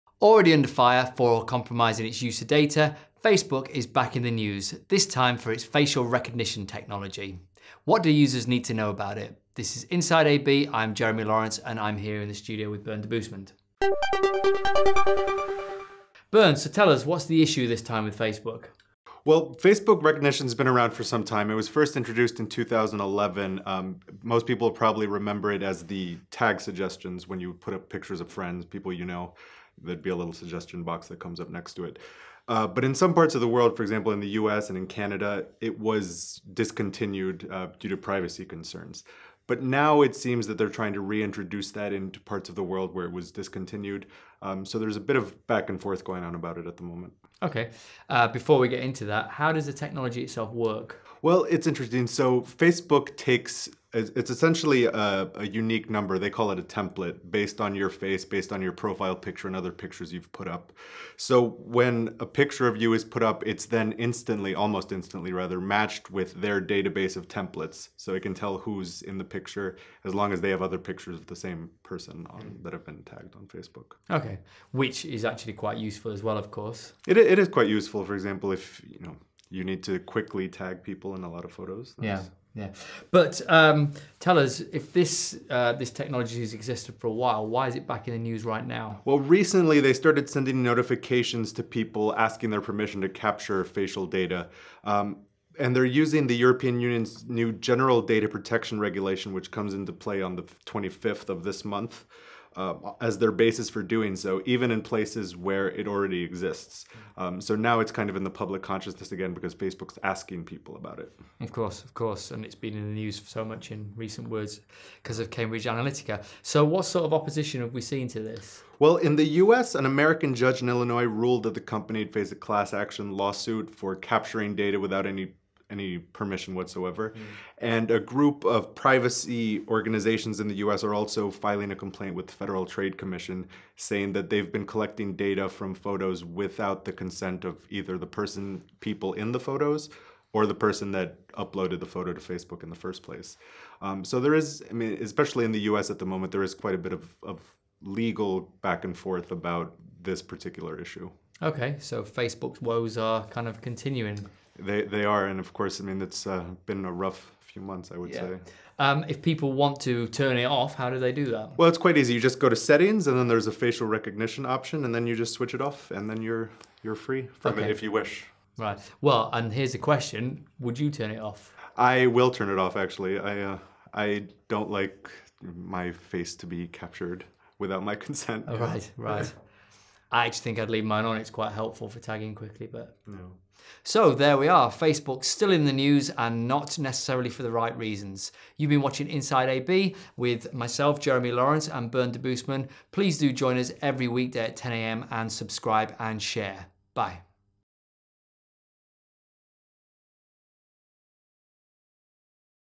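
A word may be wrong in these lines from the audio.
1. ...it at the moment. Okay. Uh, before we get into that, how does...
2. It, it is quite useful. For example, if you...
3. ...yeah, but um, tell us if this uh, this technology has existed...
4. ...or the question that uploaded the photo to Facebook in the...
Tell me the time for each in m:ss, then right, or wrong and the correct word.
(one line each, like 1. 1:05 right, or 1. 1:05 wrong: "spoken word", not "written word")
1. 0:46 right
2. 1:17 right
3. 1:22 right
4. 2:20 wrong: "person", not "question".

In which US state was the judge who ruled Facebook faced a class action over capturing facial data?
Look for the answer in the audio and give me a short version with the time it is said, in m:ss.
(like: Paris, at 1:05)
Illinois, at 2:00.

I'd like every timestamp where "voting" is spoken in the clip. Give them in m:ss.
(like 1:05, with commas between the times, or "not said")
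not said.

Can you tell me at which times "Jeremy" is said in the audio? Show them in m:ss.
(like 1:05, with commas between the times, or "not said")
0:10, 3:10.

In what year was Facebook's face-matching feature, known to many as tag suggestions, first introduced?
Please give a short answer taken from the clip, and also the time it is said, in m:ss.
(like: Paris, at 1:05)
2011, at 0:22.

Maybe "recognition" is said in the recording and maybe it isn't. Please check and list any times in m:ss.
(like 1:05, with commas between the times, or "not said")
0:06, 0:20, 2:43.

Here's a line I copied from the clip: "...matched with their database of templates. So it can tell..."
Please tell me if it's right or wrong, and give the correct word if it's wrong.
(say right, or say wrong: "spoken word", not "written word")
right.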